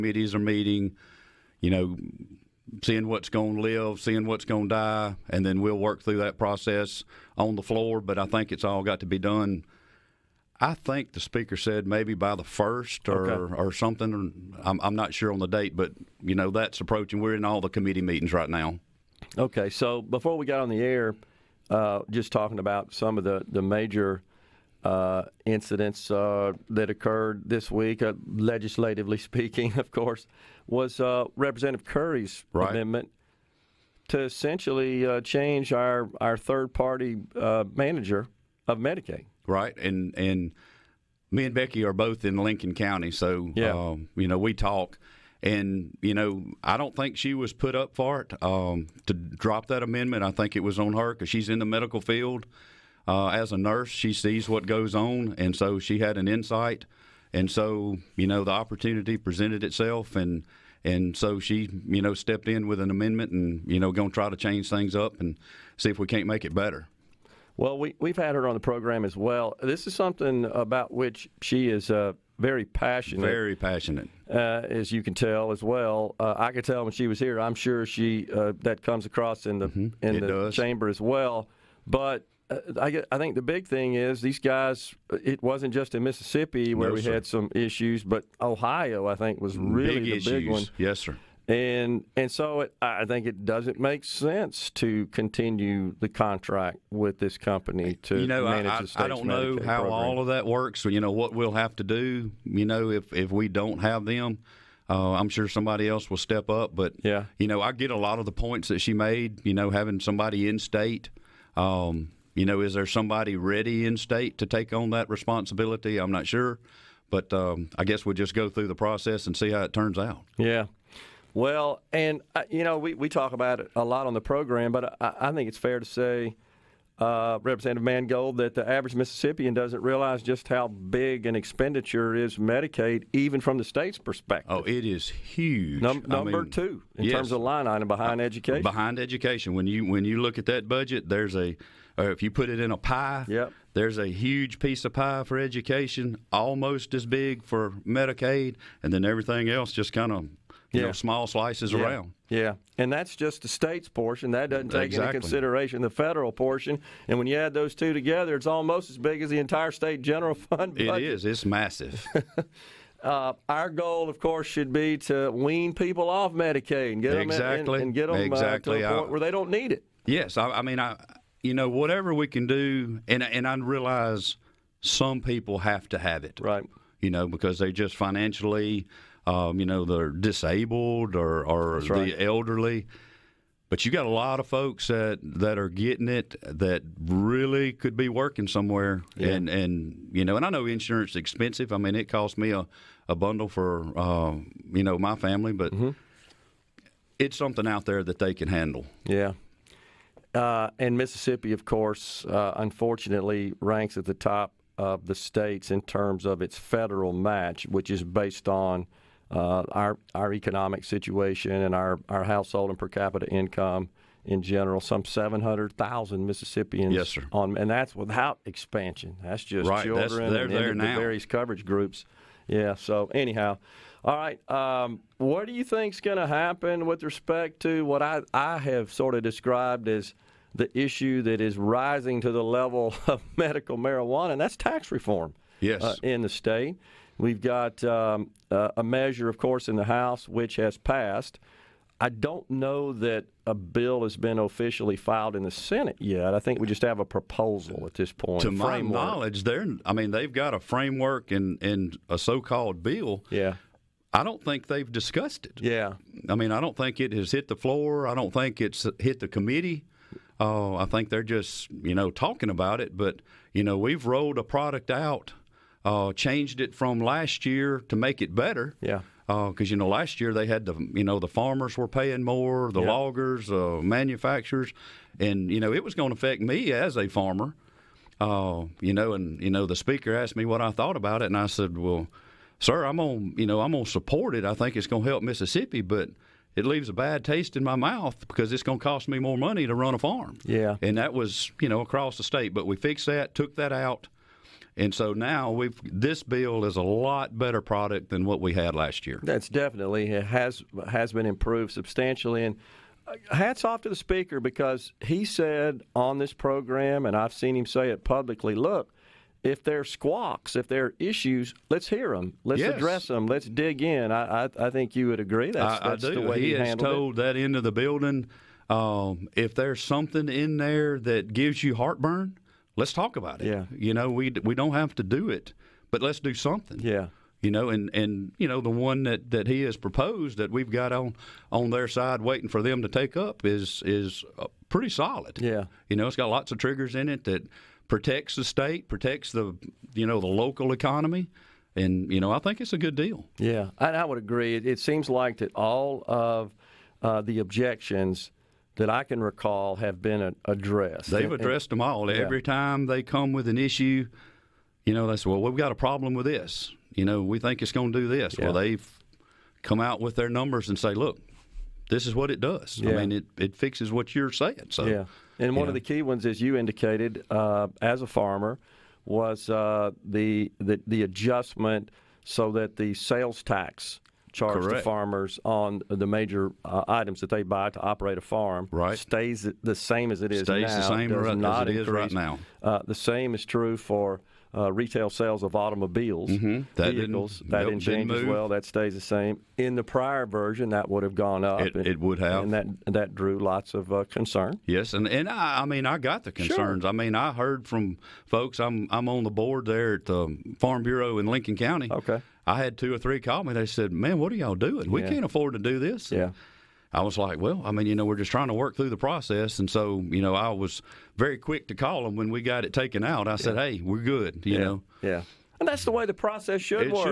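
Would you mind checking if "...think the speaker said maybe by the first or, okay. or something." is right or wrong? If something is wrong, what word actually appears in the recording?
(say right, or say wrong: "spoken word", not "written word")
right.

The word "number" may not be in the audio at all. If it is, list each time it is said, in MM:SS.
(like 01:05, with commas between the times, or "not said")
02:16, 06:00.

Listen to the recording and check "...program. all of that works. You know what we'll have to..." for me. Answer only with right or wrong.
right.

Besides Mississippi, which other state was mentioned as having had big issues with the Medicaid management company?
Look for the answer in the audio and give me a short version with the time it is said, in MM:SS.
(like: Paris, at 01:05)
Ohio, at 01:28.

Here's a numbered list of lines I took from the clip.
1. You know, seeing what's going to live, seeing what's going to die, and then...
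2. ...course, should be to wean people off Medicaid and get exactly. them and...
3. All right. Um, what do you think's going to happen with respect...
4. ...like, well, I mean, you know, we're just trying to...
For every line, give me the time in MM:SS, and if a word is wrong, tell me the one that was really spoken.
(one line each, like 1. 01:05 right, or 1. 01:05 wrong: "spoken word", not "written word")
1. 00:01 right
2. 02:44 right
3. 03:44 right
4. 06:47 right.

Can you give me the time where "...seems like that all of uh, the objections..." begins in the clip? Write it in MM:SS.
05:44.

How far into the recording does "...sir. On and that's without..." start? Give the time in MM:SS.
03:37.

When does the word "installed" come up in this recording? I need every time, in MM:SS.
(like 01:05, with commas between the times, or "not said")
not said.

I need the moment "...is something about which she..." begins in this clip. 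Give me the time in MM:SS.
01:09.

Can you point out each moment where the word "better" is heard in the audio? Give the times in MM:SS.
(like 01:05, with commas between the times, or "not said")
01:06, 04:28, 04:57.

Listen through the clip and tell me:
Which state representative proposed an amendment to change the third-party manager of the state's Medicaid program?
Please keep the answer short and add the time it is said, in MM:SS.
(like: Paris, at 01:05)
Representative Currie, at 00:31.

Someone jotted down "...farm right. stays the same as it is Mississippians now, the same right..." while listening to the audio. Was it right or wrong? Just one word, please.
wrong.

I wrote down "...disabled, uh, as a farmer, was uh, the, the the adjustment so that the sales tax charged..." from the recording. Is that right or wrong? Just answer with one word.
wrong.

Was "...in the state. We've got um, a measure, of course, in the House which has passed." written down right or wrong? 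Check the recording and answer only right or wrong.
right.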